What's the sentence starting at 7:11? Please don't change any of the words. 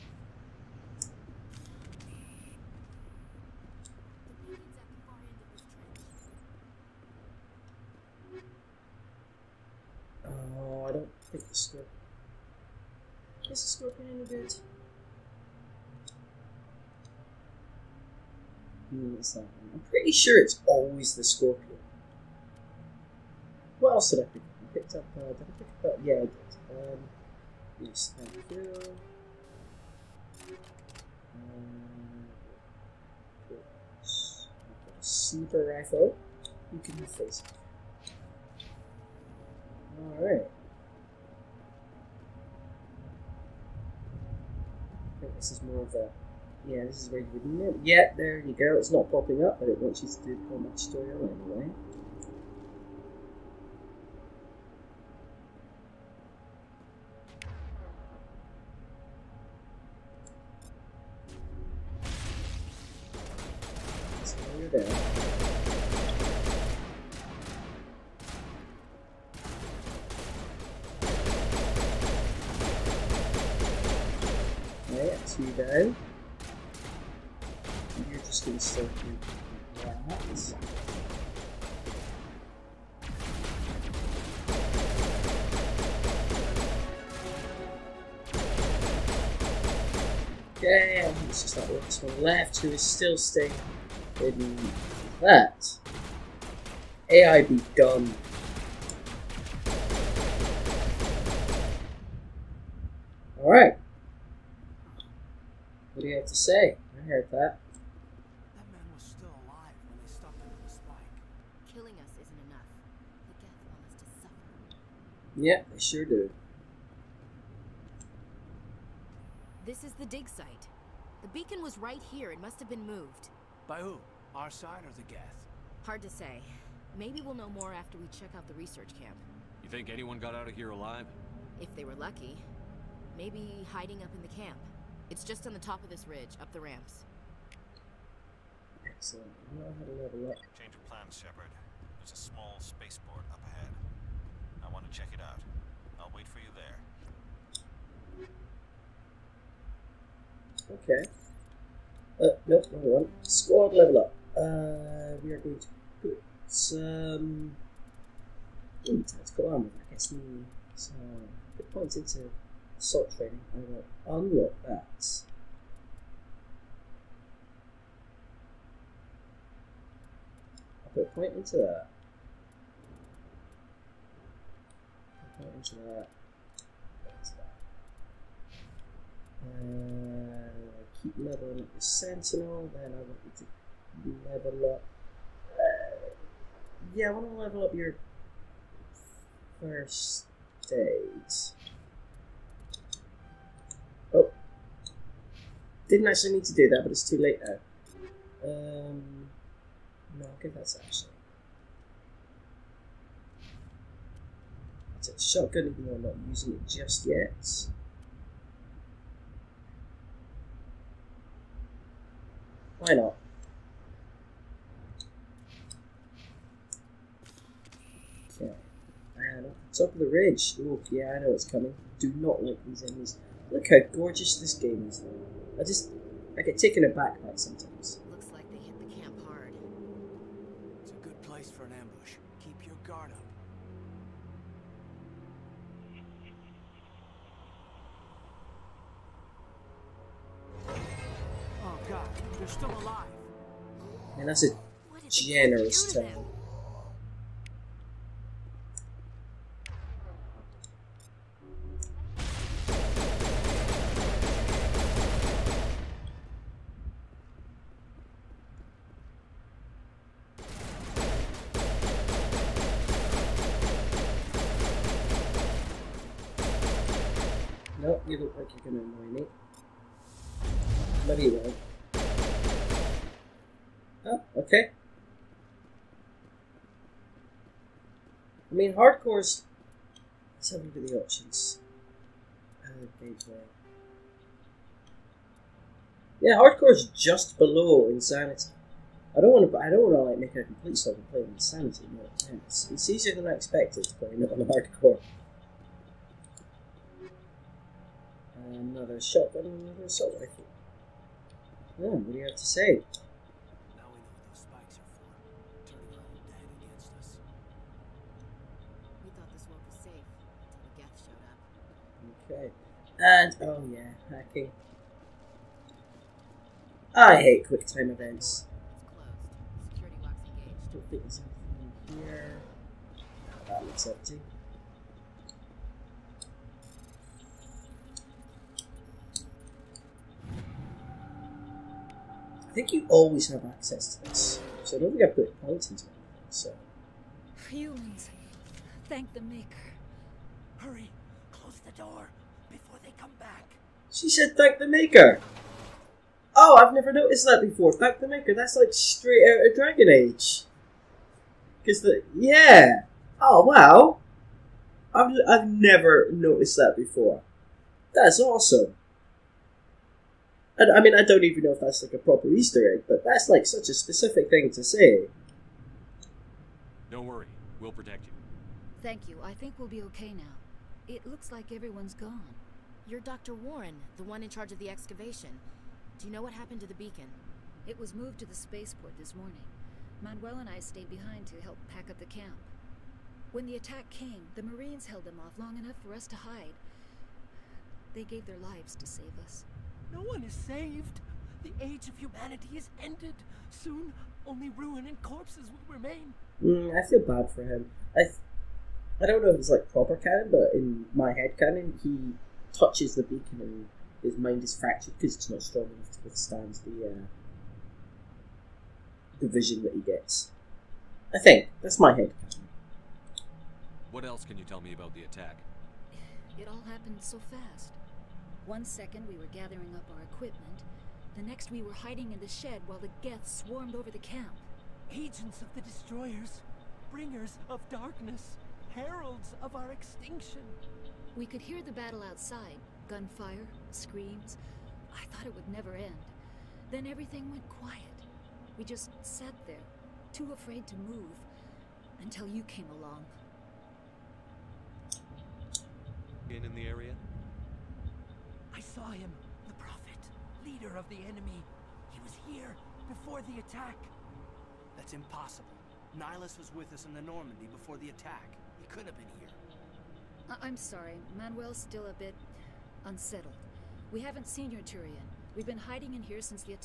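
We could hear the battle outside.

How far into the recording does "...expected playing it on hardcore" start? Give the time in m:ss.
4:53.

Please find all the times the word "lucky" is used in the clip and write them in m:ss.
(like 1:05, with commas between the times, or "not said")
2:11.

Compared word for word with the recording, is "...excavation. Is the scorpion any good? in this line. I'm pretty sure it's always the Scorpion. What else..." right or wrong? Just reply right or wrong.
wrong.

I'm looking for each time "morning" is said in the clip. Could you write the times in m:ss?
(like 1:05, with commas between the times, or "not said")
6:19.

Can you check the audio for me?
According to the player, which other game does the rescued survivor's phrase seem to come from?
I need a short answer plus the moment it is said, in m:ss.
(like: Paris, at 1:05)
Dragon Age, at 5:49.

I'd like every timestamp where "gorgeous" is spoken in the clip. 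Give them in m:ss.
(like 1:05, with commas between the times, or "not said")
3:43.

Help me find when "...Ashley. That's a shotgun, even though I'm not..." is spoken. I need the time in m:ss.
3:20.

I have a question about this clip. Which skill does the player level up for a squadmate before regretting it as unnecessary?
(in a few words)
First aid.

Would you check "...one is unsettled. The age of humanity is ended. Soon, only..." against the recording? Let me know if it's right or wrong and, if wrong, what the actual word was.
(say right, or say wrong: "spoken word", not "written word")
wrong: "saved", not "unsettled".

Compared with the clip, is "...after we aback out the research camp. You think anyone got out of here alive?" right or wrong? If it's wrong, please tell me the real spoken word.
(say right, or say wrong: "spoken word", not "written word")
wrong: "check", not "aback".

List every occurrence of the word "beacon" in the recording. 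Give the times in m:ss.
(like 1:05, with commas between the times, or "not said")
2:01, 6:16, 6:43.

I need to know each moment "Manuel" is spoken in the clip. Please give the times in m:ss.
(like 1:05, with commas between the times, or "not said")
6:20, 7:41.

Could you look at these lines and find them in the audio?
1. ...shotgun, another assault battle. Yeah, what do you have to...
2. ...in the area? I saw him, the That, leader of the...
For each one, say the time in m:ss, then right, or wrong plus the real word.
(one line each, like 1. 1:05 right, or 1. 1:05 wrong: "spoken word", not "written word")
1. 4:59 wrong: "rifle", not "battle"
2. 7:26 wrong: "Prophet", not "That".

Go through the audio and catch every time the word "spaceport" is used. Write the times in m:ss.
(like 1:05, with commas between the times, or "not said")
2:22, 6:18.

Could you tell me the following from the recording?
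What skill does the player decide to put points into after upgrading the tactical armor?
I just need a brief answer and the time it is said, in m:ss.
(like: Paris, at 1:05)
Assault training, at 2:42.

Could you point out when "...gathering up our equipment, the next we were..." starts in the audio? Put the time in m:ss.
6:59.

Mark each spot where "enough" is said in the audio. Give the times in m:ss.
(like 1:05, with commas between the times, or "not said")
1:52, 6:25, 6:45.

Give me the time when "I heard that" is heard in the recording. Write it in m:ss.
1:46.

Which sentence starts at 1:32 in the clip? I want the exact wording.
to is still staying in that.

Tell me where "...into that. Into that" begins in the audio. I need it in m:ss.
2:55.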